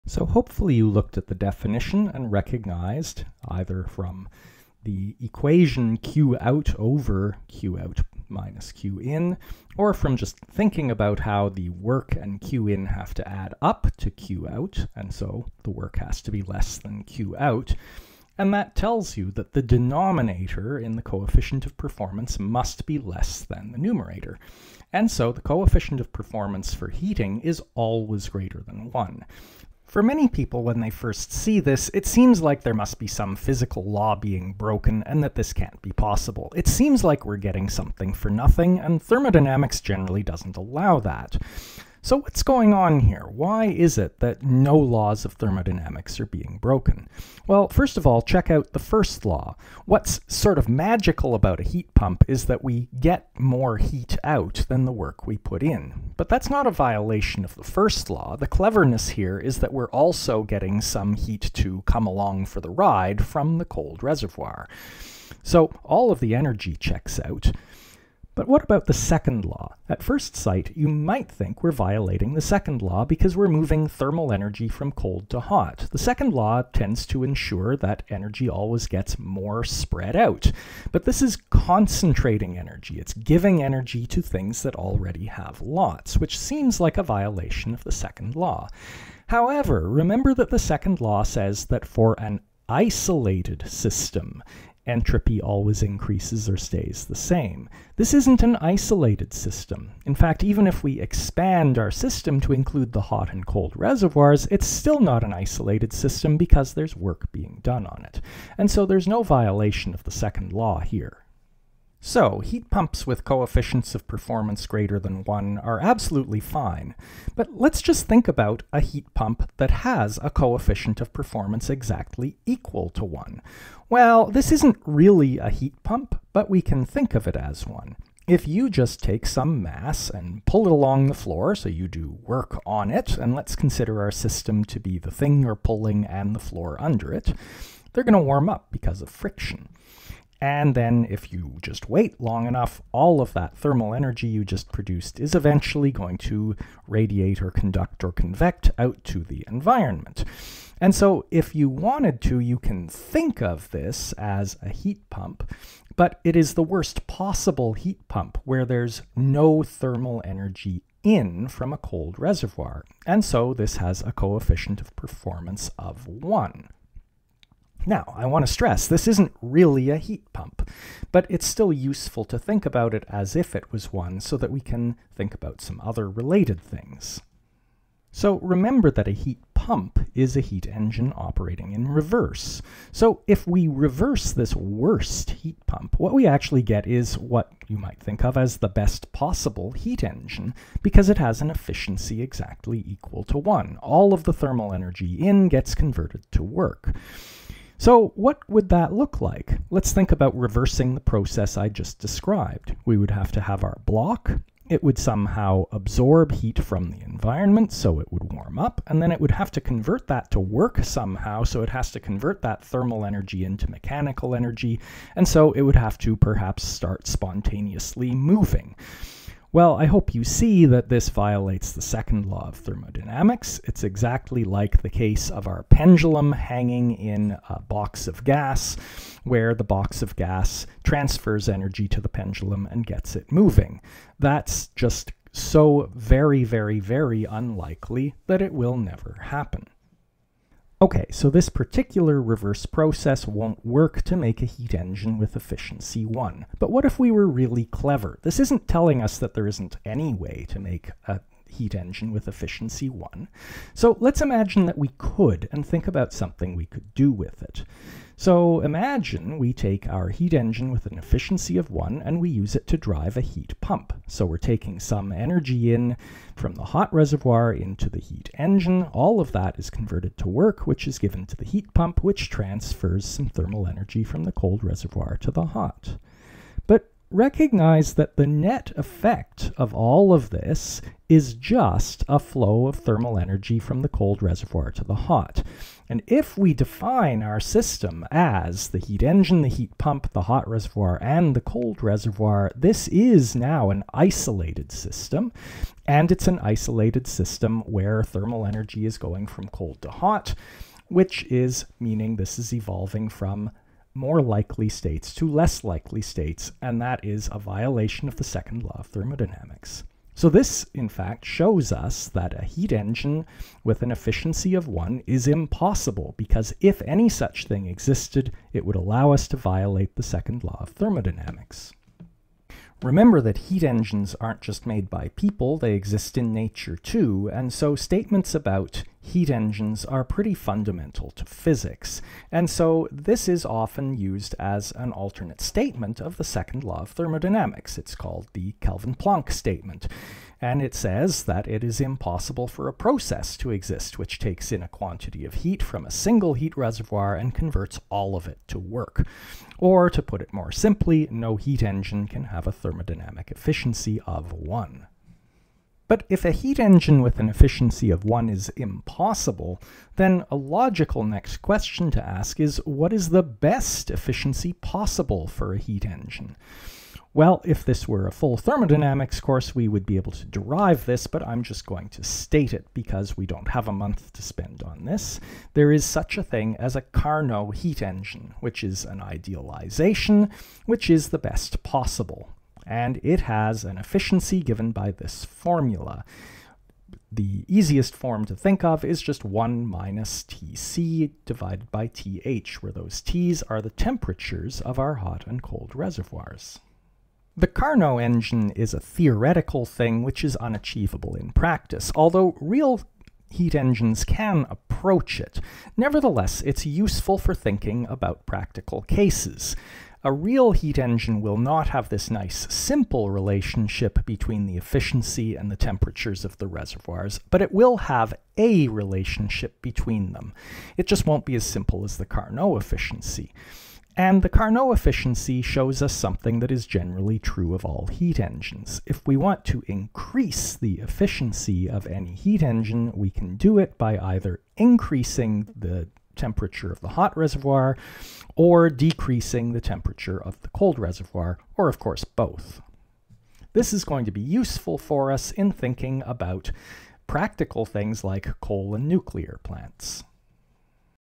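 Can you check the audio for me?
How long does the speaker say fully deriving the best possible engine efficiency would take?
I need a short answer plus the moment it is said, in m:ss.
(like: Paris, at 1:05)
a month, at 6:13.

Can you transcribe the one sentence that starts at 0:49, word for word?
What's sort of magical about a heat pump is that we get more heat out than the work we put in.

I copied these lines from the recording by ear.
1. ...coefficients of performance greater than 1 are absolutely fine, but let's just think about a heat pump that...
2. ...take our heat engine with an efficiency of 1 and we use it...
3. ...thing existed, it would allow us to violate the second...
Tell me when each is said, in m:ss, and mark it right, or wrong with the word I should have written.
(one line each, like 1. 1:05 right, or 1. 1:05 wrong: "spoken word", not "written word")
1. 1:53 right
2. 4:19 right
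3. 5:17 right.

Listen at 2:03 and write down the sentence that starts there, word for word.
Well, this isn't really a heat pump, but we can think of it as one.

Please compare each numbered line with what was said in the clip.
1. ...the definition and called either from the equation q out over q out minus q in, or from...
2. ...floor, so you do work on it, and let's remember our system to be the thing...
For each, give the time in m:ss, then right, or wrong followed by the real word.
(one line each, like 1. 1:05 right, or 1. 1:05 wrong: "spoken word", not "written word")
1. 0:01 wrong: "recognized", not "called"
2. 2:11 wrong: "consider", not "remember".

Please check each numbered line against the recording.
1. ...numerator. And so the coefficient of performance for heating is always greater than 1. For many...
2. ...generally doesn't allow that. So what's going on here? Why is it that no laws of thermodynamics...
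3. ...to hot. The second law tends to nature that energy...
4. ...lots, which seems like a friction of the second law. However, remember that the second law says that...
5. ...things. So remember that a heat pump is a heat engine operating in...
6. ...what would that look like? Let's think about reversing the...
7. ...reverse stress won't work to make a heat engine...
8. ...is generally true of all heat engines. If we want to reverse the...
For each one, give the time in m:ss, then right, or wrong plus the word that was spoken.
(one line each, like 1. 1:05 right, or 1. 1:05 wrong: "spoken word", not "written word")
1. 0:23 right
2. 0:39 right
3. 1:15 wrong: "ensure", not "nature"
4. 1:25 wrong: "violation", not "friction"
5. 2:56 right
6. 3:18 right
7. 4:02 wrong: "process", not "stress"
8. 7:06 wrong: "increase", not "reverse".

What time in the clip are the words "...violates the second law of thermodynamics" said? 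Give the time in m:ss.
3:41.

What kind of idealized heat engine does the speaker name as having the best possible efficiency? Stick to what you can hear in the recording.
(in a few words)
Carnot heat engine.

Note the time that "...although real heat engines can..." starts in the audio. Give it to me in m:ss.
6:41.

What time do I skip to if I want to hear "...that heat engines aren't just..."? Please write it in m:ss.
5:23.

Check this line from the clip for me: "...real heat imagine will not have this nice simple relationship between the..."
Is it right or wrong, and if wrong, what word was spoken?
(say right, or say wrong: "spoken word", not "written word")
wrong: "engine", not "imagine".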